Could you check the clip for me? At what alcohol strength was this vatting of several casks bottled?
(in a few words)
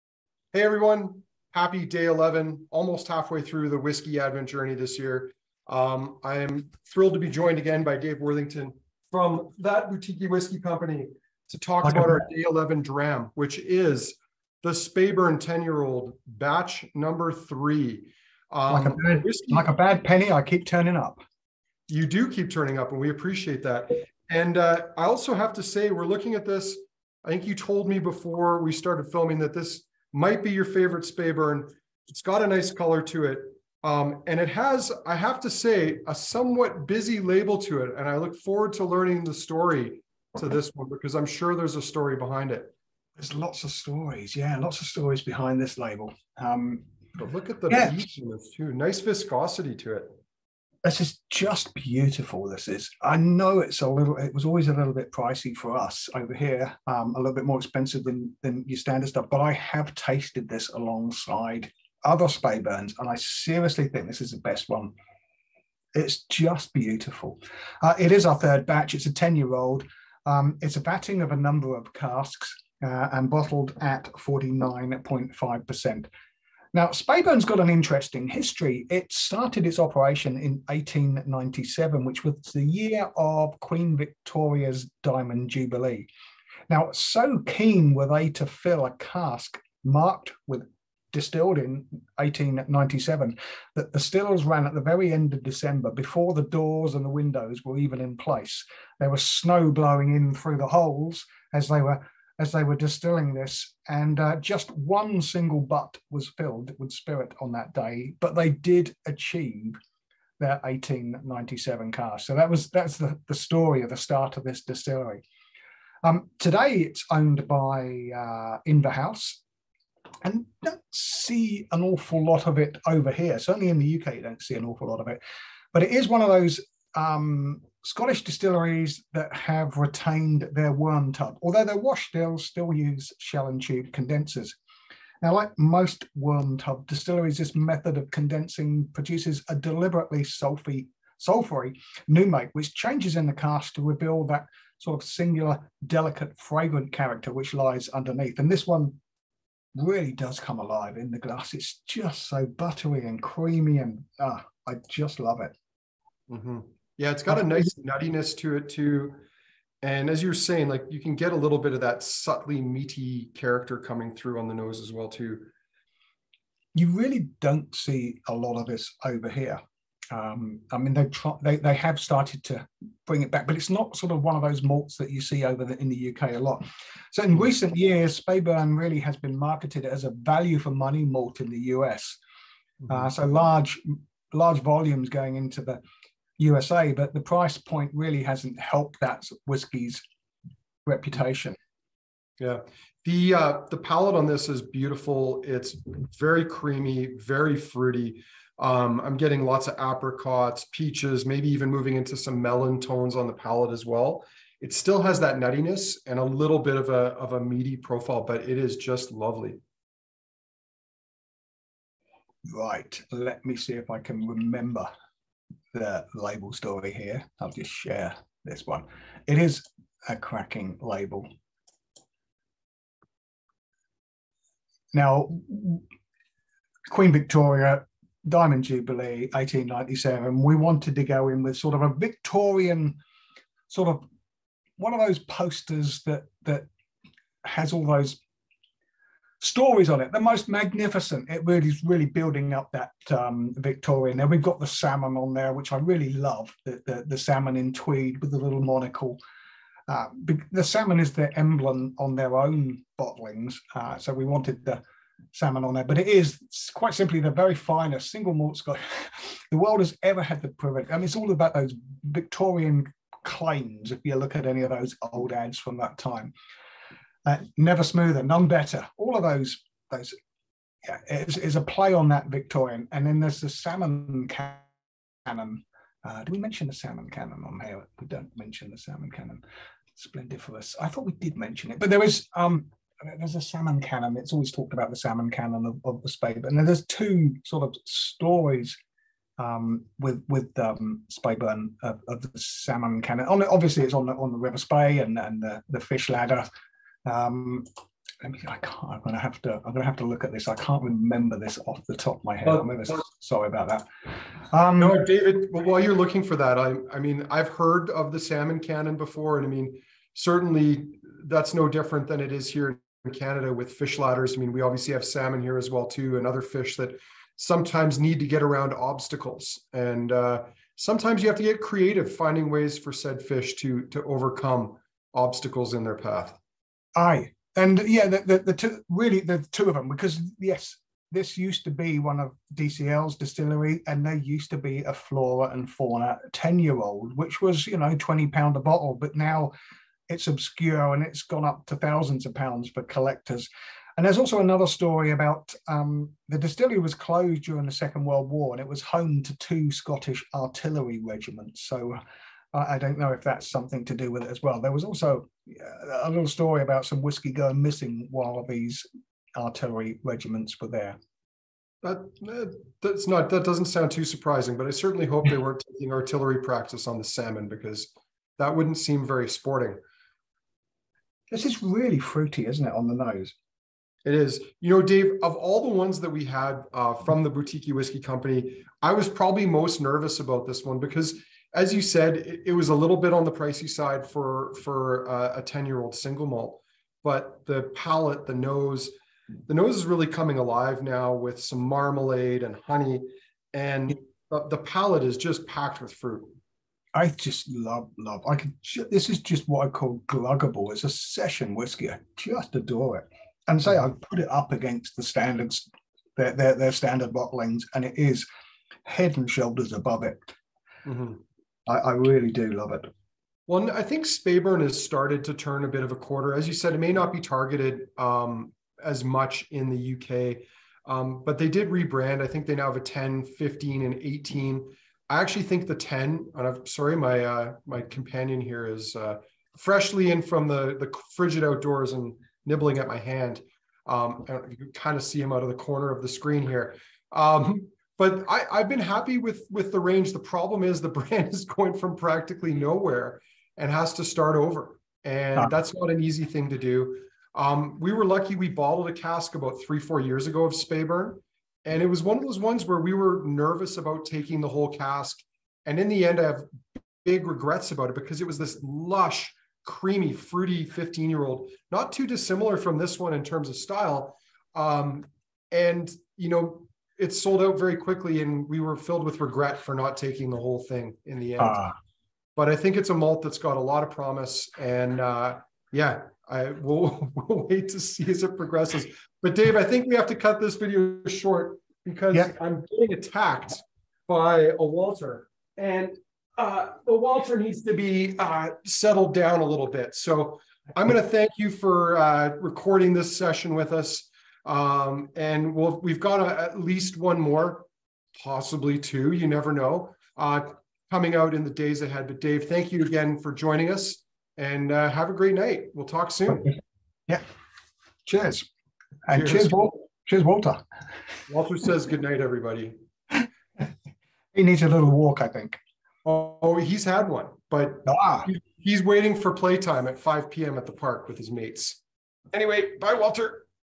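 49.5%.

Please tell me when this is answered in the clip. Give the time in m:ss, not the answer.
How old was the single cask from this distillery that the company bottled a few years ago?
7:40.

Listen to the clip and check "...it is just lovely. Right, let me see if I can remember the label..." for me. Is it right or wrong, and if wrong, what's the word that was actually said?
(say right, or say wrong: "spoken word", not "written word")
right.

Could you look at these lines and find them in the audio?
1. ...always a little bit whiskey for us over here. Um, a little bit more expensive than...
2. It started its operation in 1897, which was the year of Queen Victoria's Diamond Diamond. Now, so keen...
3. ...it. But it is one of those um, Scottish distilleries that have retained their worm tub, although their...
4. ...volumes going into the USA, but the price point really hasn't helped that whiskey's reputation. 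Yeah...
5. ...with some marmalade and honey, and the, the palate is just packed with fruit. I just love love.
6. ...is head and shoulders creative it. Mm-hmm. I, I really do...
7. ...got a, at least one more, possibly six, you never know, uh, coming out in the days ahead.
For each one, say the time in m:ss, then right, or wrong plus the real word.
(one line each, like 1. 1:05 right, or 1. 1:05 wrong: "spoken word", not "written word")
1. 0:54 wrong: "pricey", not "whiskey"
2. 1:18 wrong: "Jubilee", not "Diamond"
3. 2:05 right
4. 3:04 right
5. 6:31 right
6. 6:47 wrong: "above", not "creative"
7. 8:15 wrong: "two", not "six".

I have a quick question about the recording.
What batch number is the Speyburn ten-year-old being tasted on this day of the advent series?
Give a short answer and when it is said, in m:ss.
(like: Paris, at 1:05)
3, at 0:16.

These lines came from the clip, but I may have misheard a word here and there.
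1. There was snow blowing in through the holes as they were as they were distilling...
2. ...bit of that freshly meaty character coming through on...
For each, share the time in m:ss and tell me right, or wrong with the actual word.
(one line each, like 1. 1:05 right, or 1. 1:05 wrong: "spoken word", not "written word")
1. 1:39 right
2. 2:41 wrong: "subtly", not "freshly".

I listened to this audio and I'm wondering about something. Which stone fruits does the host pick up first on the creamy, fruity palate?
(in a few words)
apricots, peaches.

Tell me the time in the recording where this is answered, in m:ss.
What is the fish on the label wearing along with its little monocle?
4:07.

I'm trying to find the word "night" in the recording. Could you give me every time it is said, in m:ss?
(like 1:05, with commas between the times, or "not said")
8:25, 8:32.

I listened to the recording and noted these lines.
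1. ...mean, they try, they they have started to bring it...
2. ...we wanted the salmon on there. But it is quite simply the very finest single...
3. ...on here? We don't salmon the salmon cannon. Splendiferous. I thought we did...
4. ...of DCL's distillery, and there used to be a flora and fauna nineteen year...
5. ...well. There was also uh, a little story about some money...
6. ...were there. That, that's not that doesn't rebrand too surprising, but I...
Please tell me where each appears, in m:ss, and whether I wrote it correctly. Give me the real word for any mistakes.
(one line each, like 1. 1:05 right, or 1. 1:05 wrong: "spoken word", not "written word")
1. 2:50 right
2. 4:14 right
3. 4:37 wrong: "mention", not "salmon"
4. 5:32 wrong: "ten", not "nineteen"
5. 5:54 wrong: "whiskey", not "money"
6. 6:00 wrong: "sound", not "rebrand".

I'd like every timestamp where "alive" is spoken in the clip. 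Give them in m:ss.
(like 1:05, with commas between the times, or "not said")
2:30, 6:30.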